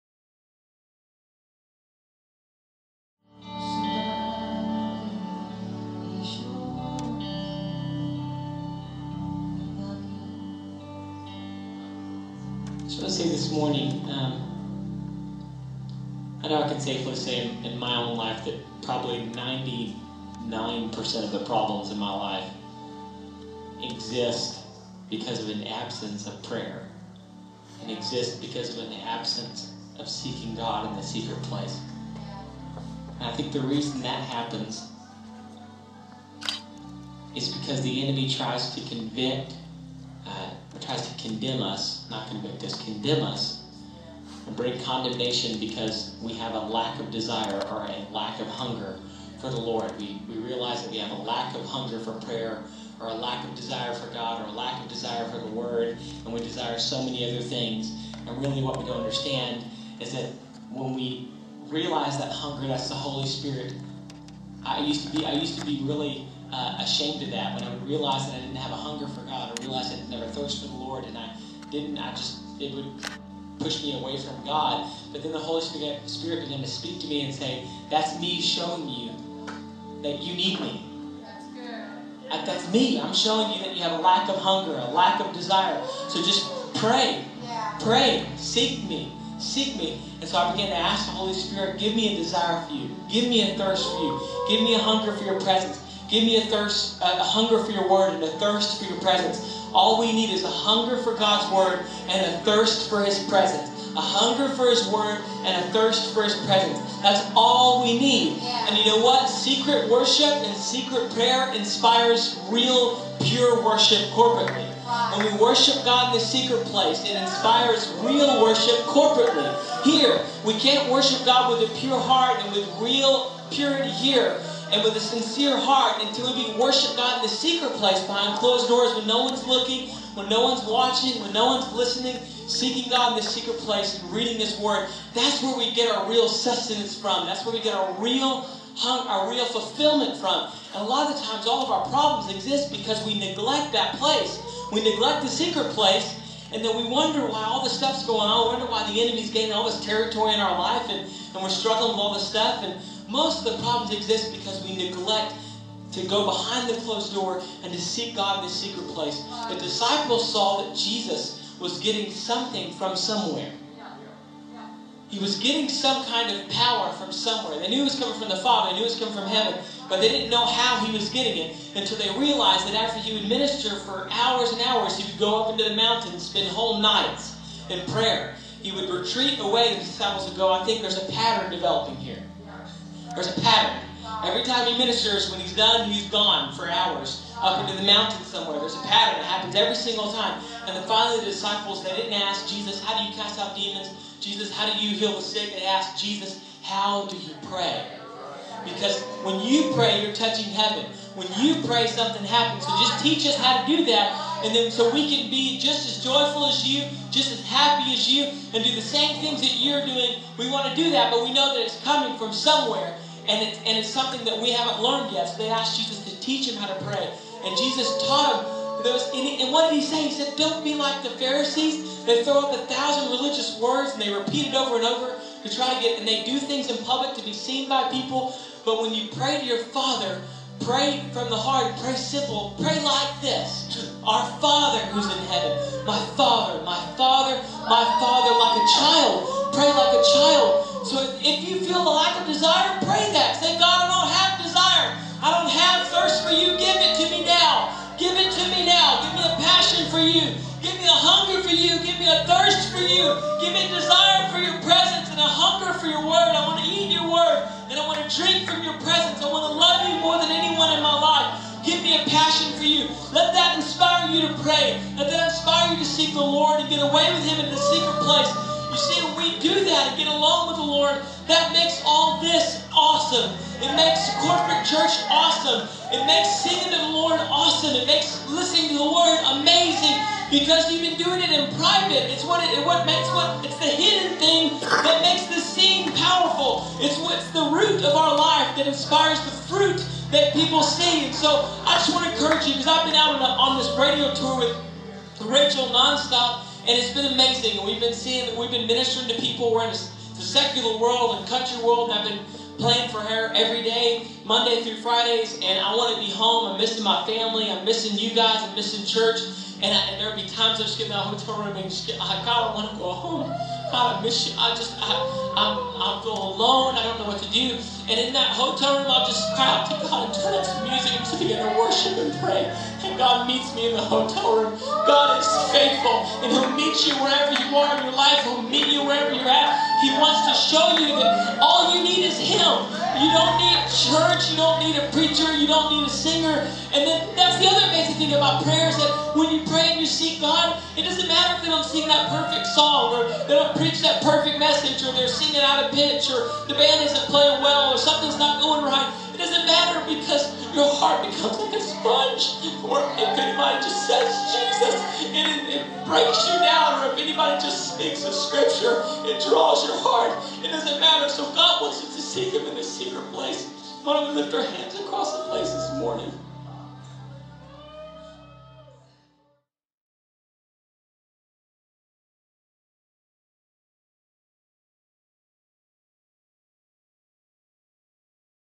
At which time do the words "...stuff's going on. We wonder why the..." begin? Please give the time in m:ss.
2:27.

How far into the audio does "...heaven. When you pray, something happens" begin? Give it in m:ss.
3:20.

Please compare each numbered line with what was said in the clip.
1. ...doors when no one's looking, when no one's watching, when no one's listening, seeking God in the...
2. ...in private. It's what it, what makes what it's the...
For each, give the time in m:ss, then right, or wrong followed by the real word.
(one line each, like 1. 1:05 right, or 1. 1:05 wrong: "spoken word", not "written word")
1. 2:08 right
2. 4:41 right.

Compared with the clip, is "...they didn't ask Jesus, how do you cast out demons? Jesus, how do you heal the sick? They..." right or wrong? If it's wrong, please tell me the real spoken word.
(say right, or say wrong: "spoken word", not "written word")
right.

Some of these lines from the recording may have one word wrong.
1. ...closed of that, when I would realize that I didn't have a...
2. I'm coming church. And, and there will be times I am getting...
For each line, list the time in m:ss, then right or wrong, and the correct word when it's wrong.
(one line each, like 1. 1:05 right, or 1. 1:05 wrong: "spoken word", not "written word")
1. 1:06 wrong: "ashamed", not "closed"
2. 5:08 wrong: "missing", not "coming".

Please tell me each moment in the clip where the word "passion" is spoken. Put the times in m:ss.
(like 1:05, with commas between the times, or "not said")
4:09, 4:22.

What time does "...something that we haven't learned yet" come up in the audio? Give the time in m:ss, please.
3:33.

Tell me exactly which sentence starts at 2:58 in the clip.
He would retreat away, the disciples would go, I think there's a pattern developing here.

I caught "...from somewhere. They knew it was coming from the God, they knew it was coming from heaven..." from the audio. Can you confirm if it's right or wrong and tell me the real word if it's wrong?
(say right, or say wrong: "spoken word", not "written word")
wrong: "Father", not "God".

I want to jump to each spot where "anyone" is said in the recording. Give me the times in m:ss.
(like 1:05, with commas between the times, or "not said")
4:20.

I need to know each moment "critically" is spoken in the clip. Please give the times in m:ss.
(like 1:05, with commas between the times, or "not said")
not said.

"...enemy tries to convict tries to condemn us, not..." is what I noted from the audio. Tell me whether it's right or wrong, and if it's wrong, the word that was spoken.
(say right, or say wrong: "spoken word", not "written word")
right.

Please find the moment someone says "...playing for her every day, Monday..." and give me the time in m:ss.
5:02.